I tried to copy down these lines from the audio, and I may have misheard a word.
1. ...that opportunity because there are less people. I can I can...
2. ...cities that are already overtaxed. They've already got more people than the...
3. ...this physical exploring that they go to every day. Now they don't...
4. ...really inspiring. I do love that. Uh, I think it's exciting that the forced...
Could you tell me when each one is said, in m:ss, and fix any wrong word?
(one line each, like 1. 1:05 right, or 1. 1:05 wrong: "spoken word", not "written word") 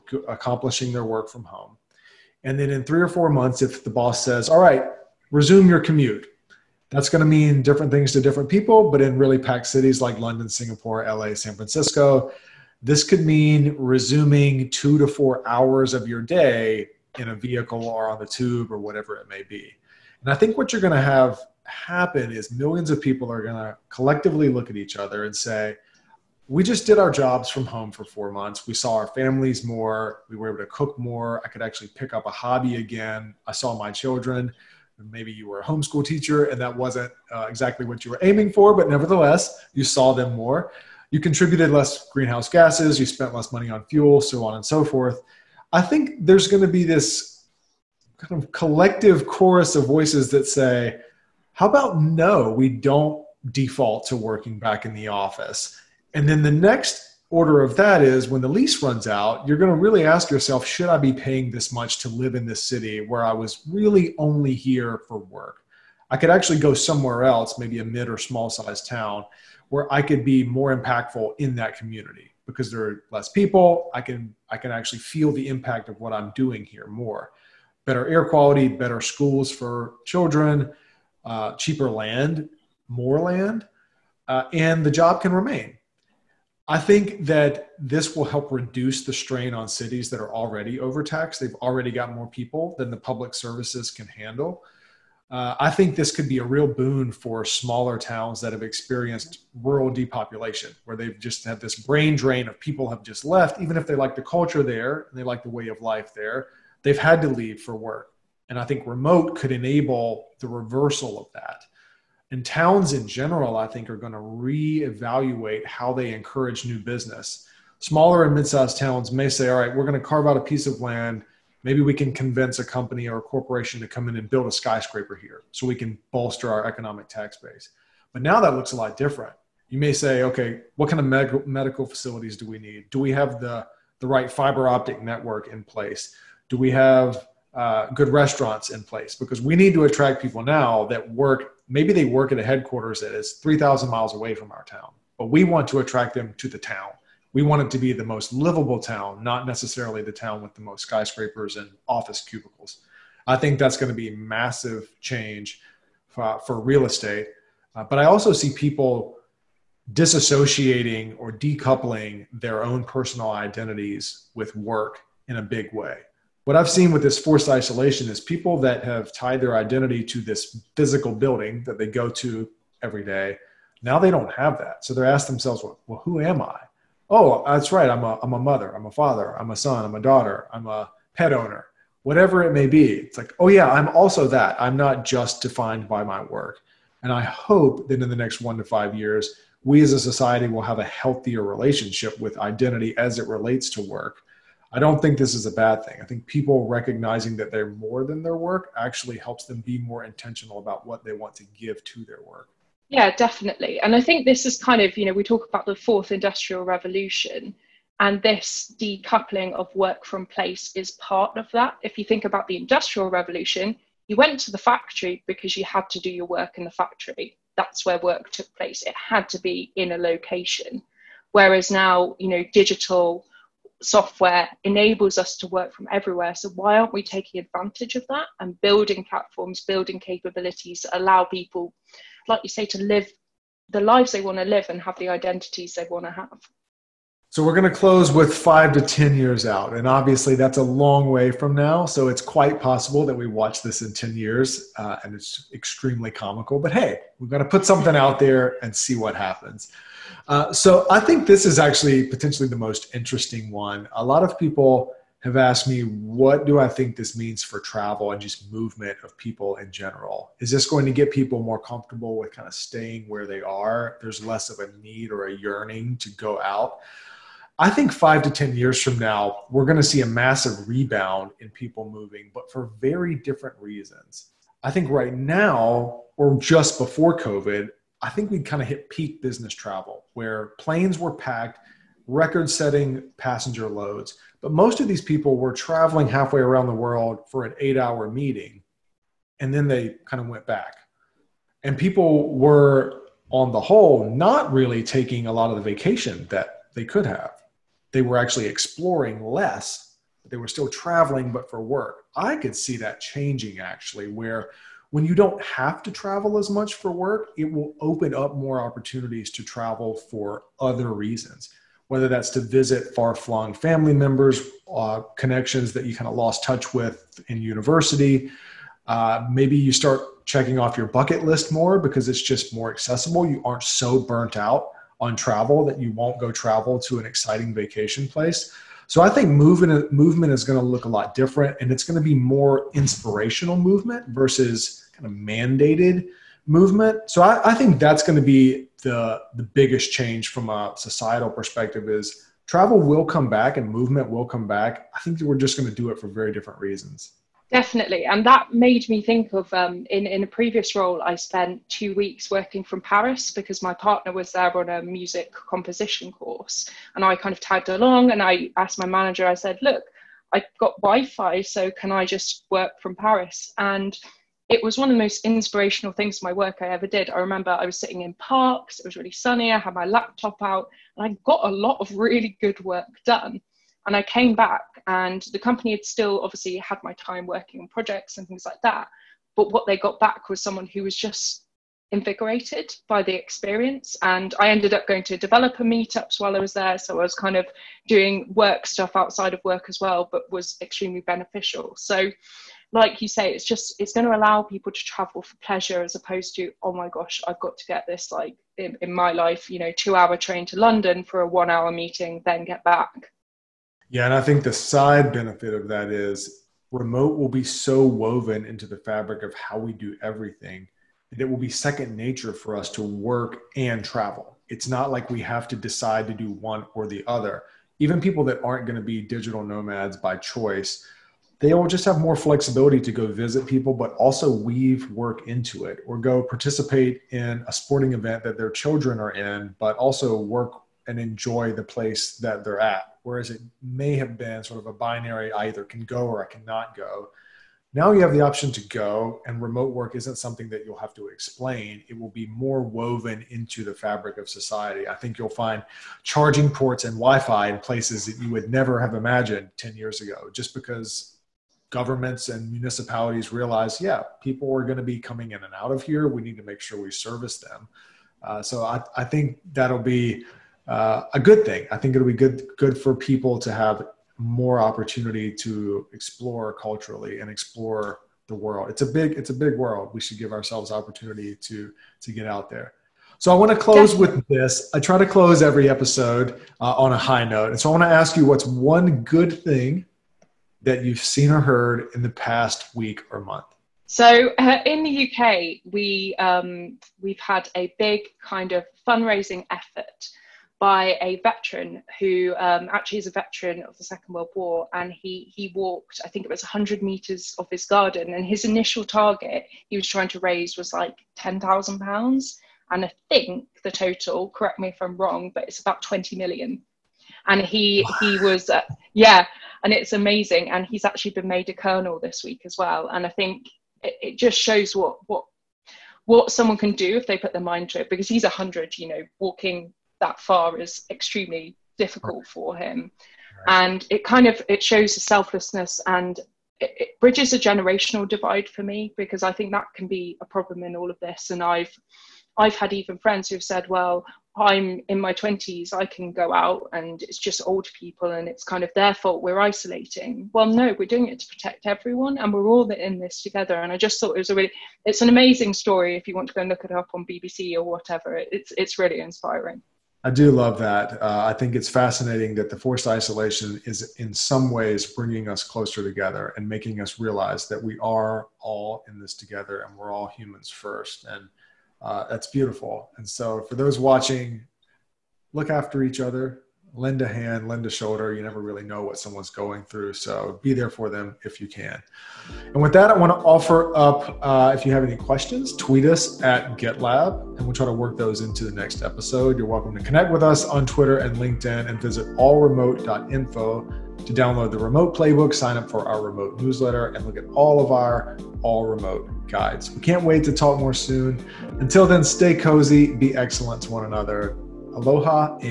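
1. 1:11 wrong: "community", not "opportunity"
2. 1:29 right
3. 2:50 wrong: "building", not "exploring"
4. 9:08 wrong: "fascinating", not "exciting".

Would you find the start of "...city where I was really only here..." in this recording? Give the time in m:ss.
1:02.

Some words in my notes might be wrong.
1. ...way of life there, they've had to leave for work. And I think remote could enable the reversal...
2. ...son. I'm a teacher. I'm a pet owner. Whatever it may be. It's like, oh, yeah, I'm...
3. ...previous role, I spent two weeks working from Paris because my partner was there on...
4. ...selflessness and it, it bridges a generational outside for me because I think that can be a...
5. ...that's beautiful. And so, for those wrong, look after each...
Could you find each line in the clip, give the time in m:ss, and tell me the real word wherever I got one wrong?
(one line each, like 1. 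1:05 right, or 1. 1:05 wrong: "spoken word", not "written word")
1. 1:45 right
2. 2:59 wrong: "daughter", not "teacher"
3. 5:50 right
4. 8:45 wrong: "divide", not "outside"
5. 9:22 wrong: "watching", not "wrong".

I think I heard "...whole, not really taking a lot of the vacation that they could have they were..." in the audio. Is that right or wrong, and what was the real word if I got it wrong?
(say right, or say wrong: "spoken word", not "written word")
right.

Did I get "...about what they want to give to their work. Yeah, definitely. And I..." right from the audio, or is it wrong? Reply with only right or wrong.
right.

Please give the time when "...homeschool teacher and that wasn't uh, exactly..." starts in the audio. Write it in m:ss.
0:35.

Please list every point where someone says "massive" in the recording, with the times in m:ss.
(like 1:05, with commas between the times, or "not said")
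2:34, 4:30.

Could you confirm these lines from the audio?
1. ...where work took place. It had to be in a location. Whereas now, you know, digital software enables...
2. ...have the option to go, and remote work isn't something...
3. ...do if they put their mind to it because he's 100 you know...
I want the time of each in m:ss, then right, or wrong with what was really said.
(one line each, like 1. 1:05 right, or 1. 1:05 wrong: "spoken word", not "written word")
1. 3:37 right
2. 7:18 right
3. 8:36 right.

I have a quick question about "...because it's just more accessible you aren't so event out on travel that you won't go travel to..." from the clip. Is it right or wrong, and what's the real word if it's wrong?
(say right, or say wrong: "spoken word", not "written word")
wrong: "burnt", not "event".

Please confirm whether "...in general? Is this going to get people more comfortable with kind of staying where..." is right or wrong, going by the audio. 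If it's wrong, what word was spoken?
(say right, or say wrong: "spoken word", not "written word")
right.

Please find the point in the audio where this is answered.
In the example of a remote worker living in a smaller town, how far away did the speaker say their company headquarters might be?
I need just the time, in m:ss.
2:23.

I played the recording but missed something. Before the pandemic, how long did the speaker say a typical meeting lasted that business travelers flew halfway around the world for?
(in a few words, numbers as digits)
8 hours.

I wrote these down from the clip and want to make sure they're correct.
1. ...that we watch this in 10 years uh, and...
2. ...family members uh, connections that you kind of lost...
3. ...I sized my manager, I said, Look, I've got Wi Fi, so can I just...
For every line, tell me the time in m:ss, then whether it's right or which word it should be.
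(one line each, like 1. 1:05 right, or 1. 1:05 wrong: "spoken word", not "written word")
1. 4:03 right
2. 5:13 right
3. 5:58 wrong: "asked", not "sized".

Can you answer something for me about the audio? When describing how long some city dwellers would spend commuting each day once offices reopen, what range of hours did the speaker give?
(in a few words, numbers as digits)
2 to 4 hours.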